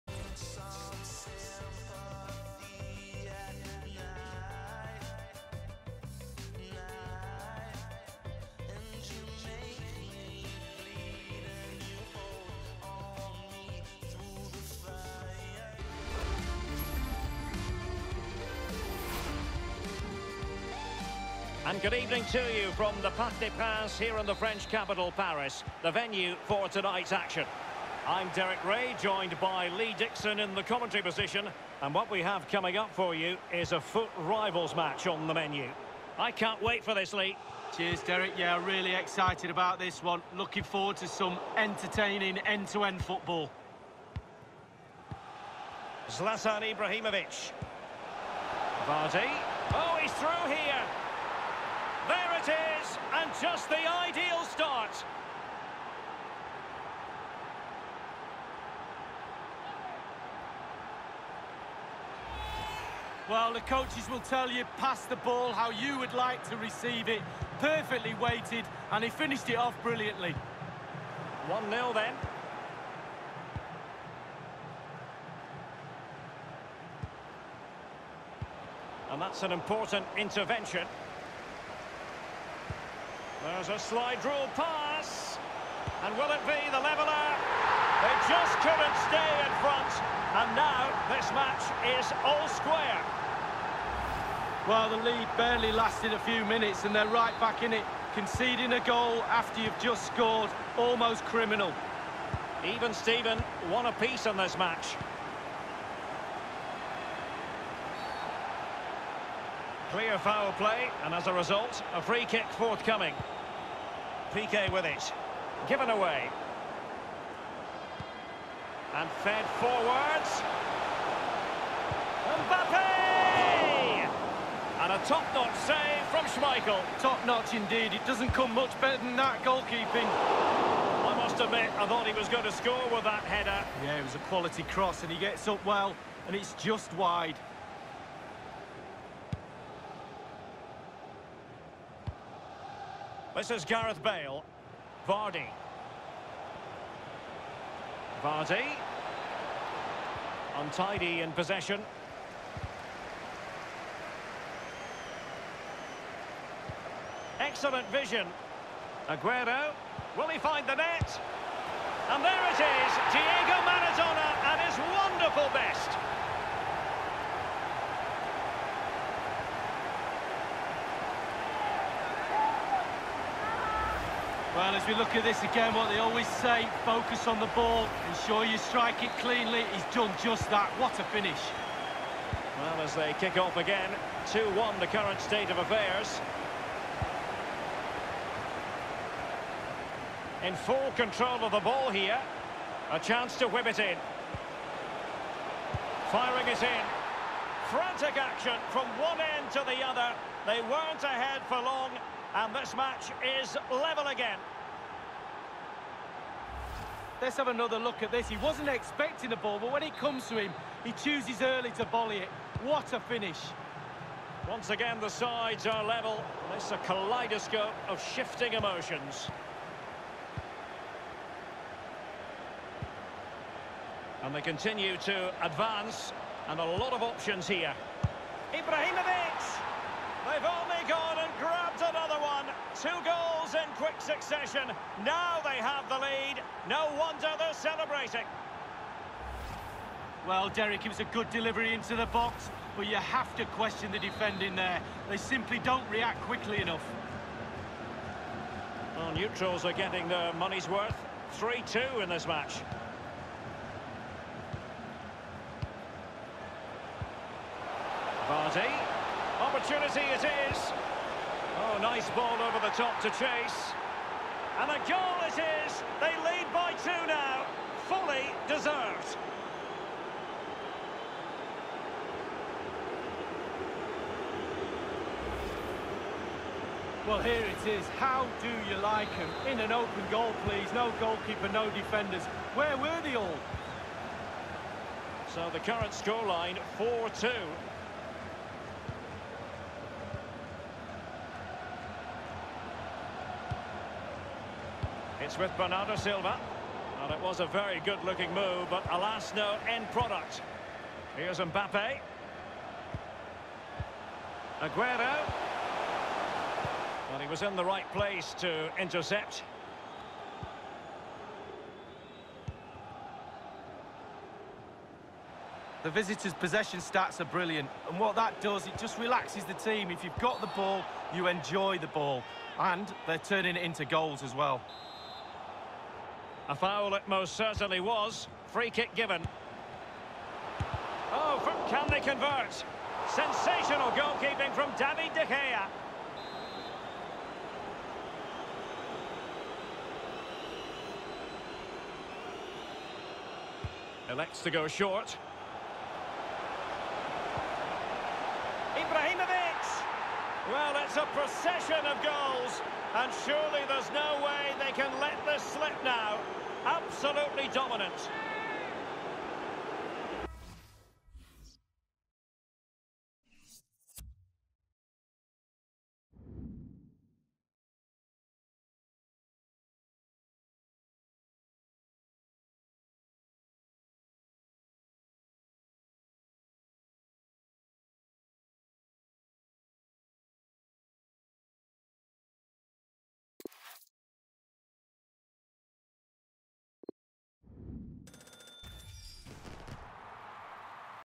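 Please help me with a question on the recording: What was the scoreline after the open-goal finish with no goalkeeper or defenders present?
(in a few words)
4-2.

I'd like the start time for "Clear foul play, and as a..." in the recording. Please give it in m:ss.
1:49.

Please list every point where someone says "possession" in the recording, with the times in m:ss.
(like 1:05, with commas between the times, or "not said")
2:31, 5:16.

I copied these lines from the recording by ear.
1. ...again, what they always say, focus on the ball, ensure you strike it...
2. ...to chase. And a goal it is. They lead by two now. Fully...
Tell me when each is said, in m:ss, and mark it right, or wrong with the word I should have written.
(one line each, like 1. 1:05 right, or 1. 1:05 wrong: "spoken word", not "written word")
1. 2:55 right
2. 4:23 right.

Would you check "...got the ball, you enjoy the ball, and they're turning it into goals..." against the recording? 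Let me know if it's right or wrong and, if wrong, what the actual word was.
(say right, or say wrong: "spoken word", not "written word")
right.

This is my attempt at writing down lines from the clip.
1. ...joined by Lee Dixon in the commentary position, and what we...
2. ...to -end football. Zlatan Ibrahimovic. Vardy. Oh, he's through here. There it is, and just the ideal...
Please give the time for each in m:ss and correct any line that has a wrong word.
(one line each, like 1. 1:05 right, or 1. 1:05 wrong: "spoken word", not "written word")
1. 0:29 right
2. 0:42 right.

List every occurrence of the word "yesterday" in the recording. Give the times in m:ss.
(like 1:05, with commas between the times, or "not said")
not said.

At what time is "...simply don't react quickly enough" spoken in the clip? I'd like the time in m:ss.
4:05.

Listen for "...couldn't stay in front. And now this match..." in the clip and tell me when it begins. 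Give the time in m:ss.
1:28.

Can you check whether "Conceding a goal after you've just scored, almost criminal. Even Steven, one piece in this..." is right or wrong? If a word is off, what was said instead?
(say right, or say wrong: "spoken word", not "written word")
right.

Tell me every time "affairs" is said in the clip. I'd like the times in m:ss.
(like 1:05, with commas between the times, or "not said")
3:05.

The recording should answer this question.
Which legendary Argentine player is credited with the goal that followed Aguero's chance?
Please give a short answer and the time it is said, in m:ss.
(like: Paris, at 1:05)
Diego Maradona, at 2:43.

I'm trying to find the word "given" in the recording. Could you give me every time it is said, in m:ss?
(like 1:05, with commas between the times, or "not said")
1:55, 5:28.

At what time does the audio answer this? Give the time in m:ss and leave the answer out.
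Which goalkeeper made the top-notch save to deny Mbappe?
2:06.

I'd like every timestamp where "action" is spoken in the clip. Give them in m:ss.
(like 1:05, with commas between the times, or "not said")
0:27, 3:18.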